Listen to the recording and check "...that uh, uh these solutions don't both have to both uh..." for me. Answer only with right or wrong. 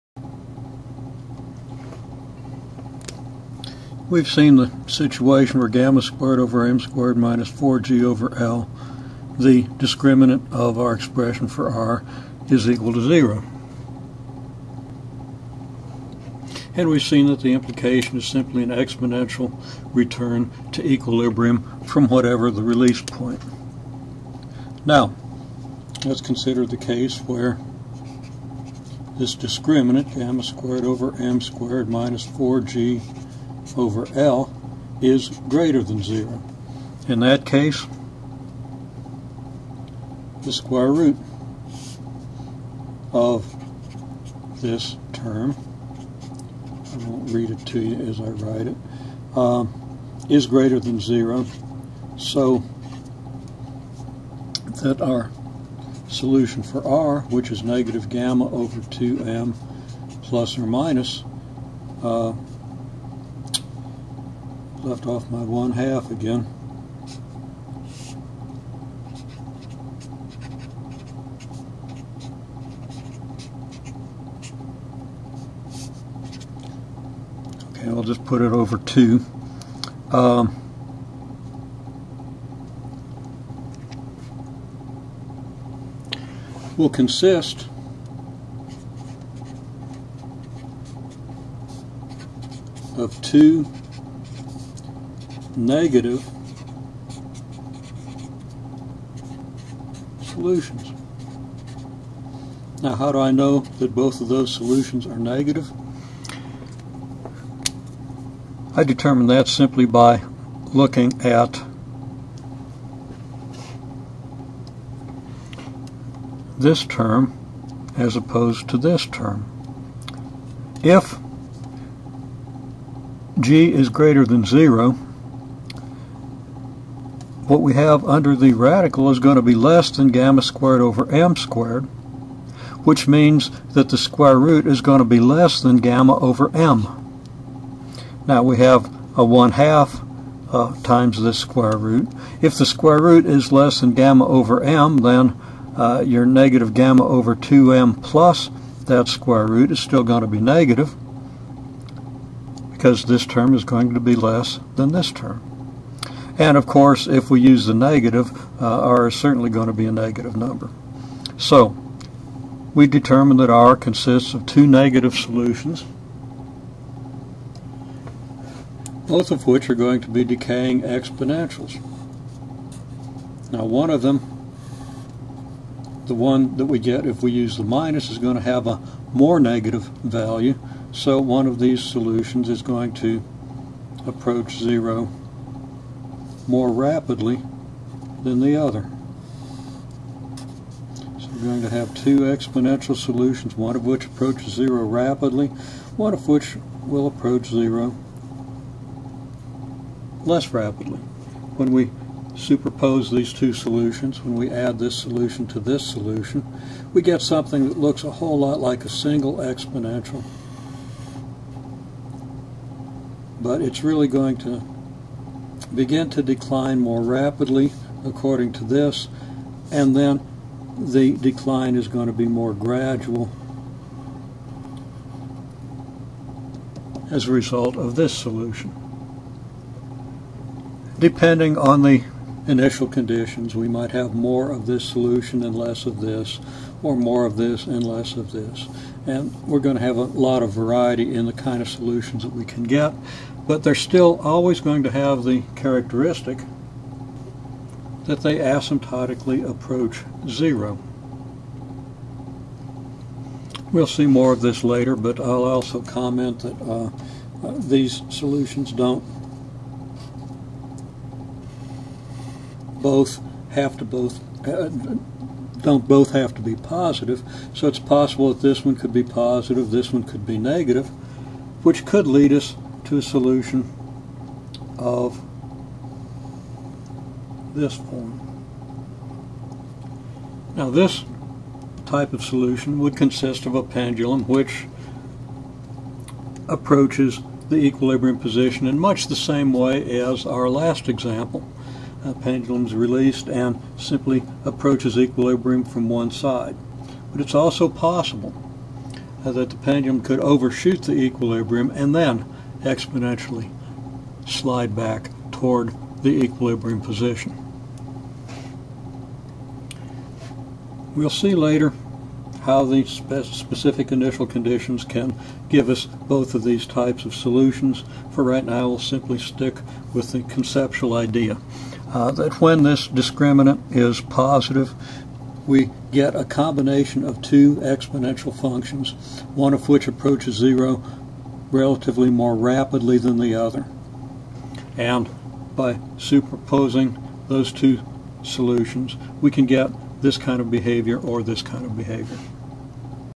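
right.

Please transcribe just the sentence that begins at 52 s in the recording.
So that our solution for R, which is negative gamma over 2m plus or minus, uh, left off my one half again.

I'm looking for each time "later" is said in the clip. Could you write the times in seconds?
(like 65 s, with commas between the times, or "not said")
254 s, 311 s.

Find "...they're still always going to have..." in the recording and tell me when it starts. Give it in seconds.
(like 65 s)
243 s.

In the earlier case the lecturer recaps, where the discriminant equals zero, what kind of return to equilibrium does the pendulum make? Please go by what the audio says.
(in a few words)
Exponential return.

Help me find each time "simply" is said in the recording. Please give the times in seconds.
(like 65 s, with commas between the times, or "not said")
18 s, 109 s, 293 s, 318 s.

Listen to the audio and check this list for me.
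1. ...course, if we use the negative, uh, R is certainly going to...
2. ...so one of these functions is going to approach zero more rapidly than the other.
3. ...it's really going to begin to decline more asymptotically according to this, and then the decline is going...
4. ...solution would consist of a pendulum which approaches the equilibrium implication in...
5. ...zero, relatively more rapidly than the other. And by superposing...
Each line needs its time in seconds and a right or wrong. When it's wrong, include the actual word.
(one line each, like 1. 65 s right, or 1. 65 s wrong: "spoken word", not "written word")
1. 156 s right
2. 180 s wrong: "solutions", not "functions"
3. 213 s wrong: "rapidly", not "asymptotically"
4. 282 s wrong: "position", not "implication"
5. 330 s right.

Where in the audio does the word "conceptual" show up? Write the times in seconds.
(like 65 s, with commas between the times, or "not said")
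320 s.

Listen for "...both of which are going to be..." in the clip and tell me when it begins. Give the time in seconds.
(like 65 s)
169 s.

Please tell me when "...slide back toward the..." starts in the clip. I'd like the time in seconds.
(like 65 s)
304 s.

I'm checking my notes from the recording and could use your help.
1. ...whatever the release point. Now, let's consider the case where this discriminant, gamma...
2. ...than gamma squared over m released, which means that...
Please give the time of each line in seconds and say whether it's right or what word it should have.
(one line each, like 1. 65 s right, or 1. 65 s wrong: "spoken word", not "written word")
1. 22 s right
2. 129 s wrong: "squared", not "released".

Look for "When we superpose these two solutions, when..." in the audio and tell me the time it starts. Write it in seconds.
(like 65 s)
201 s.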